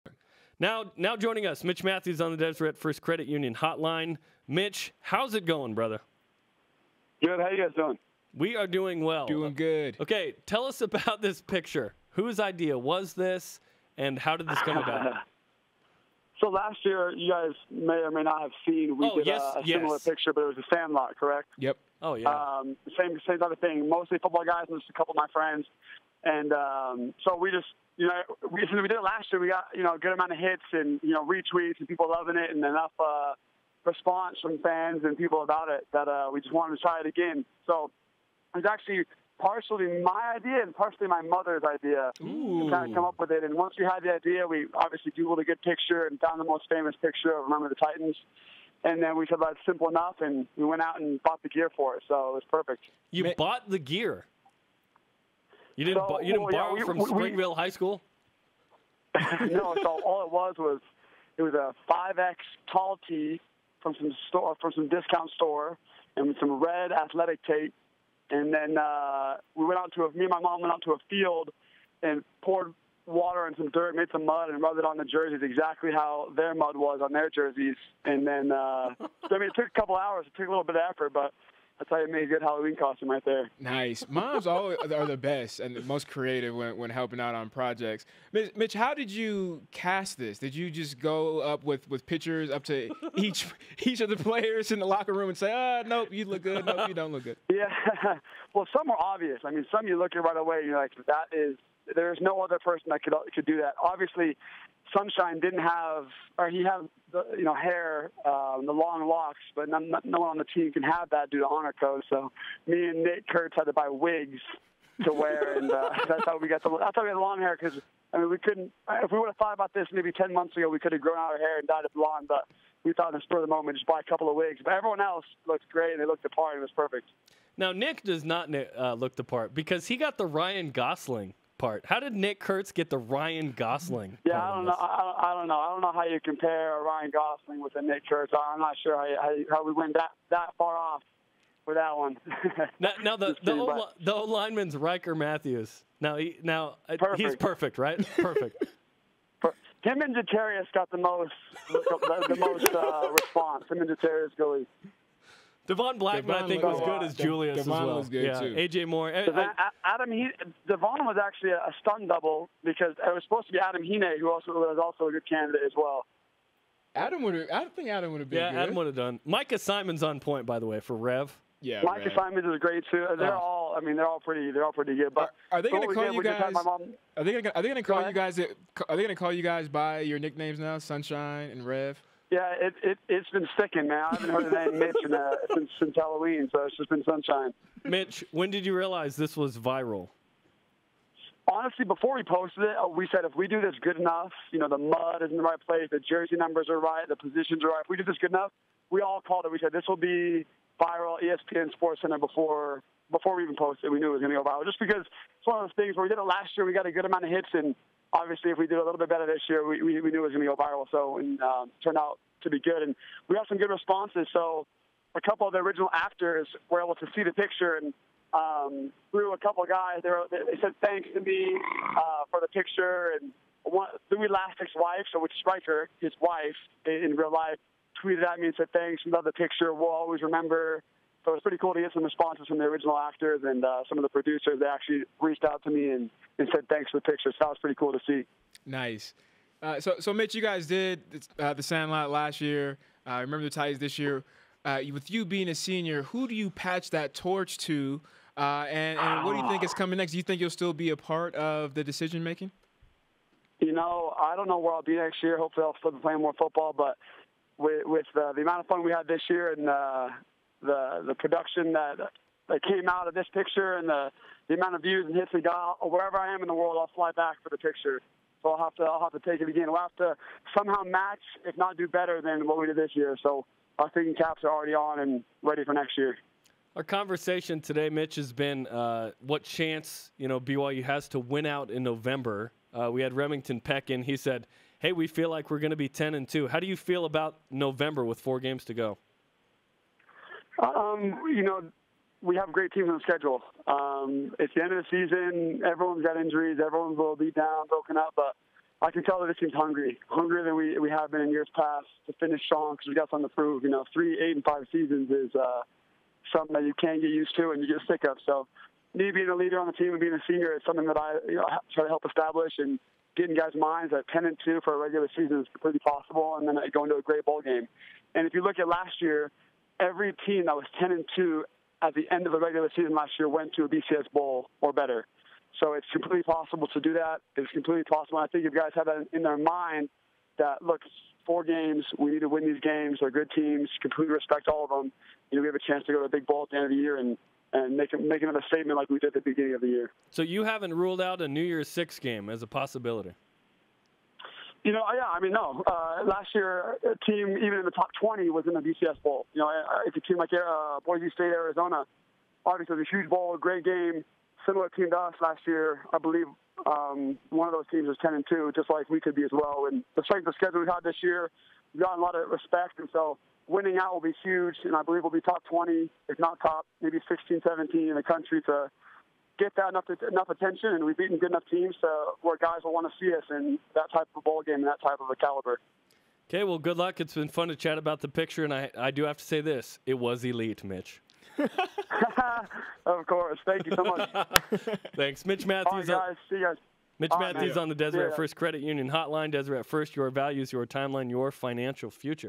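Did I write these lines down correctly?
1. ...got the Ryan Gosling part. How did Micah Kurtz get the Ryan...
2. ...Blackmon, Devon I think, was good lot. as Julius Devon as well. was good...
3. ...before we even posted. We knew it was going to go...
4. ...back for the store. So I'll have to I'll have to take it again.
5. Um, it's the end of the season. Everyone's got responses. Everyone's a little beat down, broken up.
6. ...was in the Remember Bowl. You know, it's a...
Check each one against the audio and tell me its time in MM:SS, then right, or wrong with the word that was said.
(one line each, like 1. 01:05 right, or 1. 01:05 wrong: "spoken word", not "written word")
1. 02:09 wrong: "Nick", not "Micah"
2. 02:35 right
3. 03:23 right
4. 04:27 wrong: "picture", not "store"
5. 04:53 wrong: "injuries", not "responses"
6. 05:48 wrong: "BCS", not "Remember".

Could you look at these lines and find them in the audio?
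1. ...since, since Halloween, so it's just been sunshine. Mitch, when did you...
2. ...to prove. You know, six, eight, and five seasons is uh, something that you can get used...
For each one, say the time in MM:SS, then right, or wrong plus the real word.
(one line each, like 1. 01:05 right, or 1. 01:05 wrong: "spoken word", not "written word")
1. 03:05 right
2. 05:03 wrong: "three", not "six".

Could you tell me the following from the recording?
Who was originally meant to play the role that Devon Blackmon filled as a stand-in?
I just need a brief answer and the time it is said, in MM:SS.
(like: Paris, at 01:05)
Adam Hine, at 02:43.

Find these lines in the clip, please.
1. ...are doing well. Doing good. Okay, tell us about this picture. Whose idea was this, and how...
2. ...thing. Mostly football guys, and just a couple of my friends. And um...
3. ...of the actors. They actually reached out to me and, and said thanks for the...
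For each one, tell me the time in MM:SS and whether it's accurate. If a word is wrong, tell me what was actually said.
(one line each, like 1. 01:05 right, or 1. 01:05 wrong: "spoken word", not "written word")
1. 00:08 right
2. 00:23 right
3. 03:53 wrong: "producers", not "actors".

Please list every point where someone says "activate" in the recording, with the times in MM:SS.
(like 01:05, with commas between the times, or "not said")
not said.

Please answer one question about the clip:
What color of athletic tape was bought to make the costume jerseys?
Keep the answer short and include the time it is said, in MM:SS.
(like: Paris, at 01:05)
Red, at 01:06.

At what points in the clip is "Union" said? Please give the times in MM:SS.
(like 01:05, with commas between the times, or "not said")
00:03, 06:28.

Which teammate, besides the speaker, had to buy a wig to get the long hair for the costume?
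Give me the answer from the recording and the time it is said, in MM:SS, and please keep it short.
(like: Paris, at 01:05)
Nate Kurtz, at 01:53.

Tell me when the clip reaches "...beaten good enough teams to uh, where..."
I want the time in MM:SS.
06:10.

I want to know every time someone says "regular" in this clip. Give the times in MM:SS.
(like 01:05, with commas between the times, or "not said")
05:14, 05:22.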